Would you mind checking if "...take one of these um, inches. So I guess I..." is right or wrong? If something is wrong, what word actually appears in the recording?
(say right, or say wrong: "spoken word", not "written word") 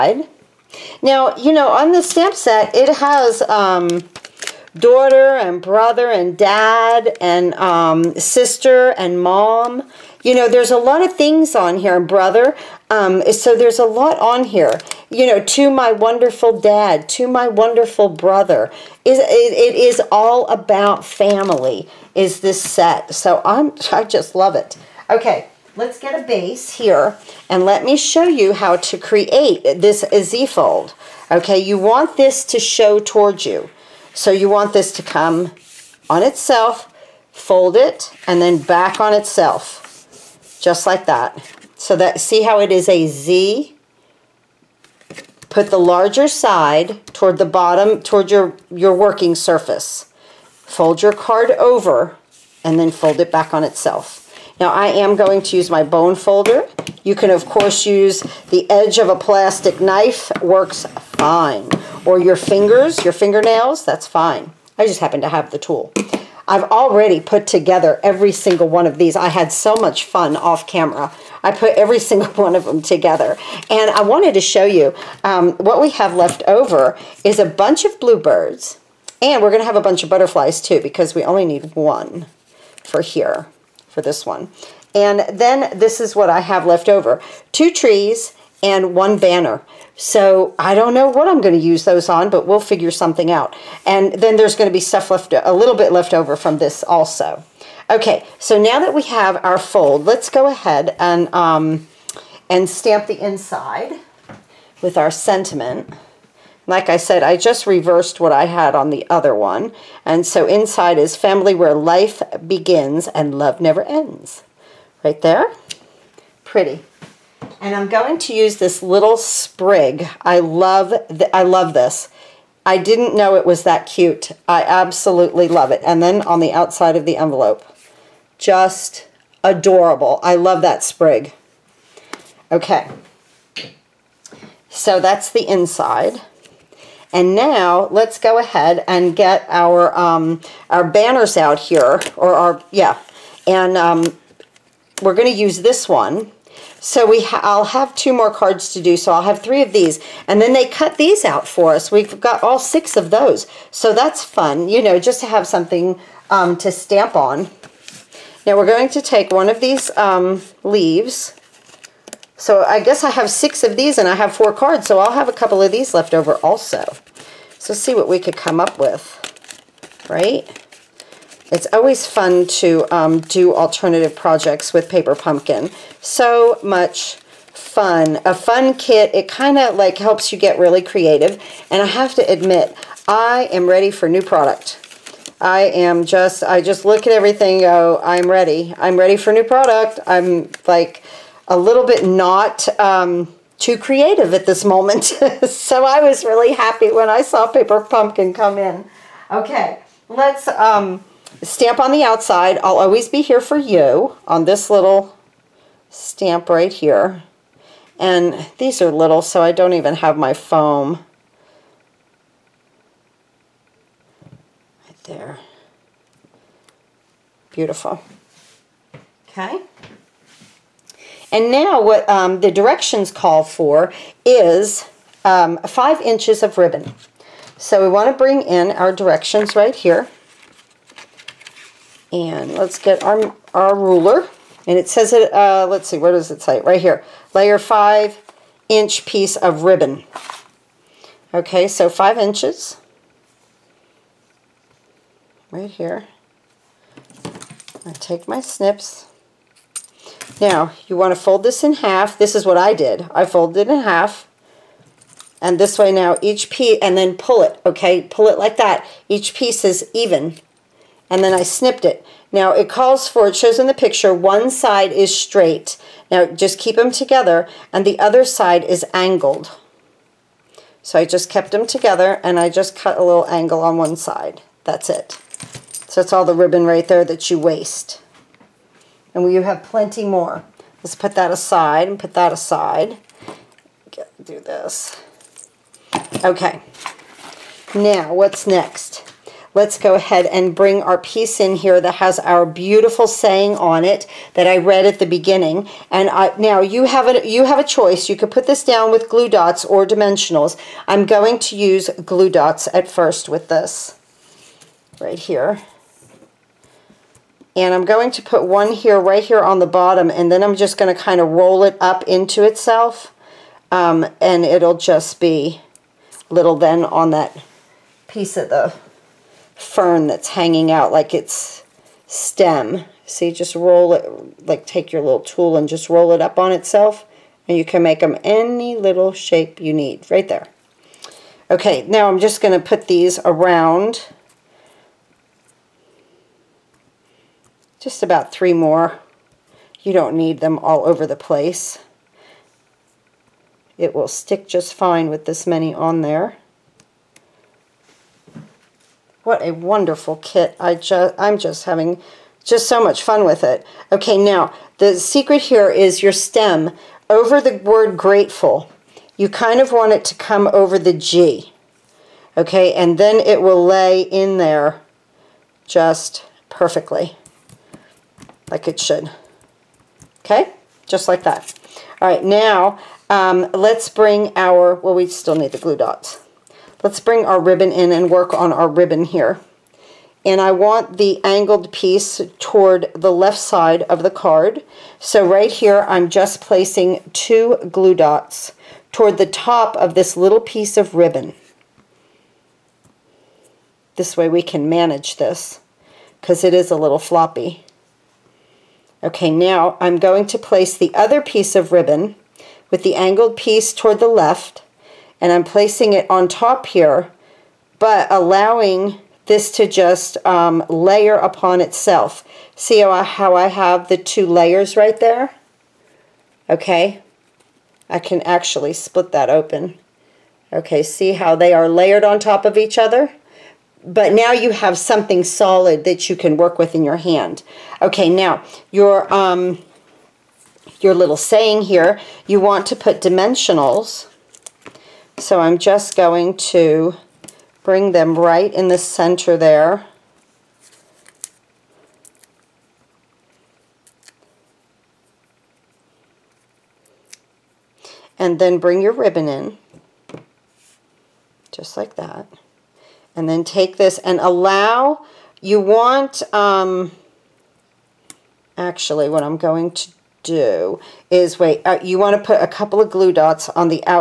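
wrong: "leaves", not "inches".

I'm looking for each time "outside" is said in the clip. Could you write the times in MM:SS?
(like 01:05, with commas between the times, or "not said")
02:06, 03:22.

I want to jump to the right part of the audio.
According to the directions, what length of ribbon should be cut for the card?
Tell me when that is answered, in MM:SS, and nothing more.
04:01.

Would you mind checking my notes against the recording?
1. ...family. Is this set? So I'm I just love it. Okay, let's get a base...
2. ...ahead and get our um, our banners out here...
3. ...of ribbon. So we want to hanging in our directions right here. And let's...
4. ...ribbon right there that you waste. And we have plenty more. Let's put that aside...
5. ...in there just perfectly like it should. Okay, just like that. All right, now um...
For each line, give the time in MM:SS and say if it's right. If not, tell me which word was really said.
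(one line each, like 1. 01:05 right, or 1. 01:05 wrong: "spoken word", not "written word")
1. 00:21 right
2. 02:18 right
3. 03:46 wrong: "bring", not "hanging"
4. 04:36 right
5. 06:04 right.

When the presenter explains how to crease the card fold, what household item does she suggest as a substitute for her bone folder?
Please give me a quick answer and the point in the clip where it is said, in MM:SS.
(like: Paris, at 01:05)
plastic knife, at 00:59.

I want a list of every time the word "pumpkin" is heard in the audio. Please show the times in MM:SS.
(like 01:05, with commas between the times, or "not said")
02:55, 03:17.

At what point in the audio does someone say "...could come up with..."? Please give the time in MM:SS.
02:48.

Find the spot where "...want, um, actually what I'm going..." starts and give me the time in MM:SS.
07:35.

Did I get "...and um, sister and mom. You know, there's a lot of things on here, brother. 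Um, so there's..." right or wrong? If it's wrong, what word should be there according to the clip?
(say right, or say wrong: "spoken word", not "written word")
right.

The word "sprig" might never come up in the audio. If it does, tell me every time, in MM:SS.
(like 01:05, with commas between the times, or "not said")
01:59, 02:10.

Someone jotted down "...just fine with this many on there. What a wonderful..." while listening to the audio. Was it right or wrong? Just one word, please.
right.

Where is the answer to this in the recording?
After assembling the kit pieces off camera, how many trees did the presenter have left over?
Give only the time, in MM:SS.
01:27.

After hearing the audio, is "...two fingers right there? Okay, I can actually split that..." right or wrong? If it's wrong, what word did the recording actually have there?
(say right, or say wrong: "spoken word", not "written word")
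wrong: "layers", not "fingers".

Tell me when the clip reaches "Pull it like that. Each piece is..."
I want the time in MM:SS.
04:18.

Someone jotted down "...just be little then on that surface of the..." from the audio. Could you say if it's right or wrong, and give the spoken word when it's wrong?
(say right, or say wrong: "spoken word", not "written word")
wrong: "piece", not "surface".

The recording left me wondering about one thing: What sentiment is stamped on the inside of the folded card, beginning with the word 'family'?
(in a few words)
family where life begins and love never ends.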